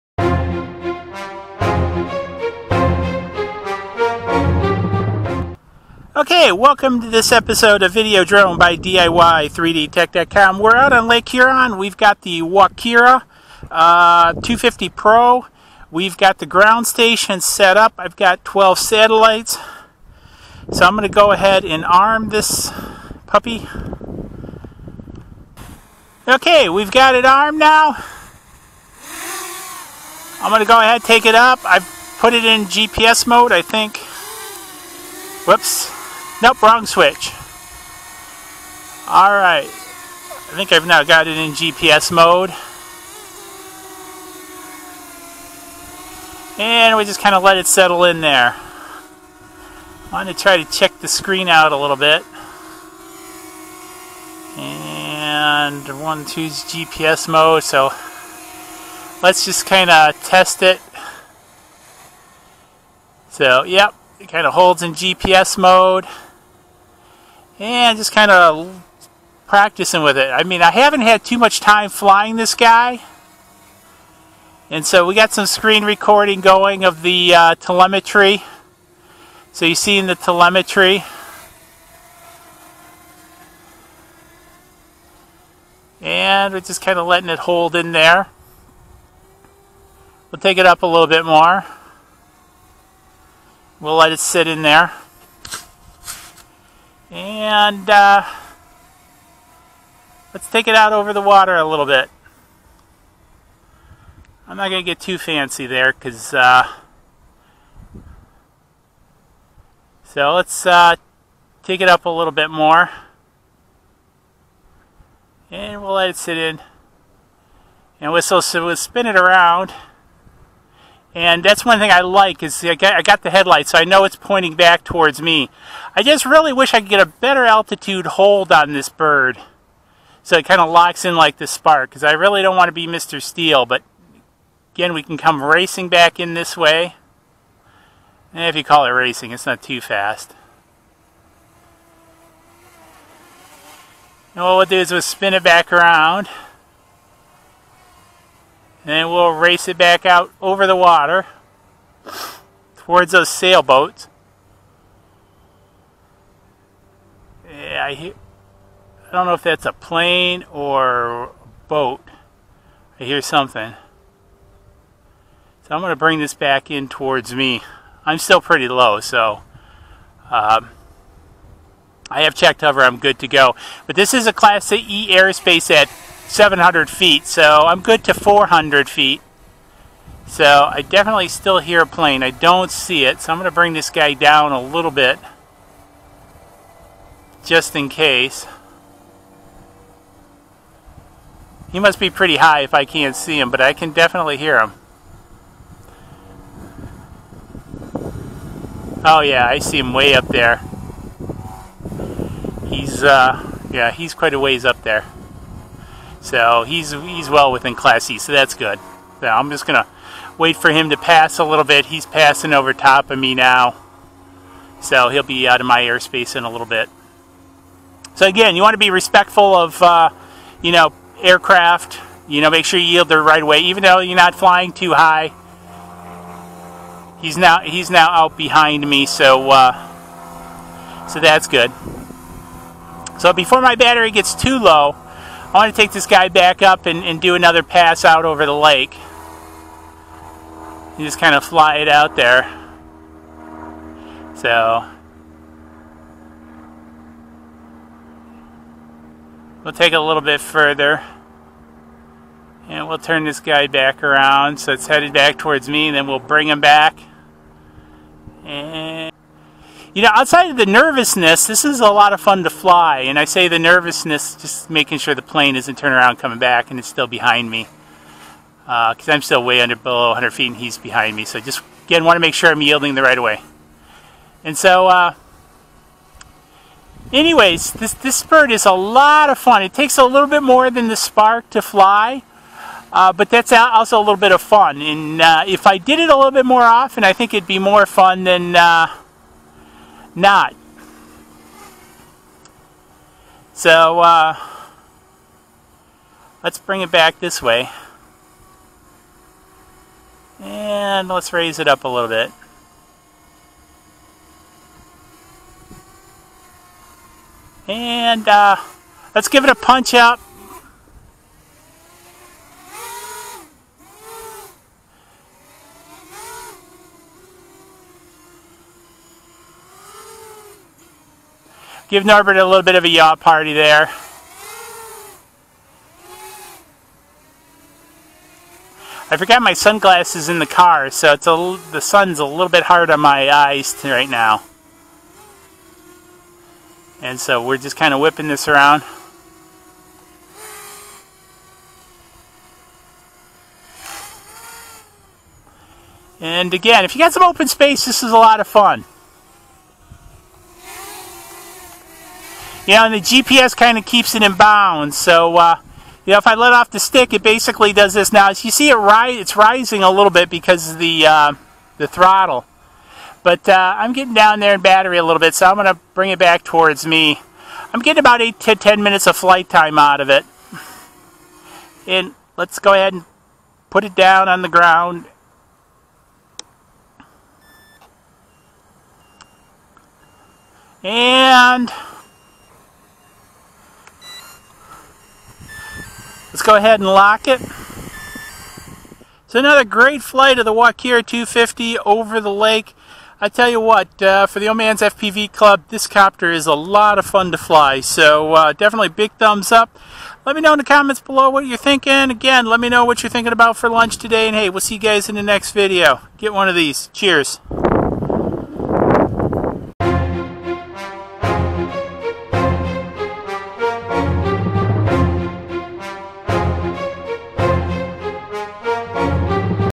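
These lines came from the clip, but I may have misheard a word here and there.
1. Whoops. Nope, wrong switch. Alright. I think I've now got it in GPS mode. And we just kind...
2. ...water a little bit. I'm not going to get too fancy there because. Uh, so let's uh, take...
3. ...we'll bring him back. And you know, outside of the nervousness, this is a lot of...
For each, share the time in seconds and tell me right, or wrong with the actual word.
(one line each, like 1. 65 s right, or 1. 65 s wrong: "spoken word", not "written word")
1. 35 s right
2. 101 s right
3. 256 s right.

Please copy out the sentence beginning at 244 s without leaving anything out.
So, we'll take it a little bit further.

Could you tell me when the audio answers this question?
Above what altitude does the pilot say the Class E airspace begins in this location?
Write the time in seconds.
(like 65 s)
176 s.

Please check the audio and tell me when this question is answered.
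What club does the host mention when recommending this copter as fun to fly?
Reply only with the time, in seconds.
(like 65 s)
394 s.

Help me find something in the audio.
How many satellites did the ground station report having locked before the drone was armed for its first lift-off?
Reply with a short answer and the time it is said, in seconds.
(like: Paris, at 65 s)
12, at 18 s.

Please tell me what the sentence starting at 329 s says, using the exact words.
I forgot my sunglasses in the car, so it's a, the sun's a little bit hard on my eyes right now.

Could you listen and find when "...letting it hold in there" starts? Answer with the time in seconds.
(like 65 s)
87 s.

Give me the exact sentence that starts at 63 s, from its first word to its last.
So, yep, it kind of holds in GPS mode and just kind of practicing with it.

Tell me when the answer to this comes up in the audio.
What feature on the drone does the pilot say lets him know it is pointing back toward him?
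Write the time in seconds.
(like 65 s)
123 s.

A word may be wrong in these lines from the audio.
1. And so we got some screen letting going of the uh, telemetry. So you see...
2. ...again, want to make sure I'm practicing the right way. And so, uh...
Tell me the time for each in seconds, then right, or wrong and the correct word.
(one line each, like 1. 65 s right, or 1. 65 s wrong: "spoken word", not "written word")
1. 74 s wrong: "recording", not "letting"
2. 271 s wrong: "yielding", not "practicing".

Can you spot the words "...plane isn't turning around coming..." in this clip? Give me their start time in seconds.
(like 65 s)
265 s.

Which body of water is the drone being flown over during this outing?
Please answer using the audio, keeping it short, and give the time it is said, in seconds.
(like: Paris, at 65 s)
Lake Huron, at 11 s.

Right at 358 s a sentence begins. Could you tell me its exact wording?
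Now, as you see, it ri it's rising a little bit because of the, uh, the throttle.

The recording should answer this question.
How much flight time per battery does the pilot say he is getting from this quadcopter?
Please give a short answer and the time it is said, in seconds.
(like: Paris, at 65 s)
8 to 10 minutes, at 368 s.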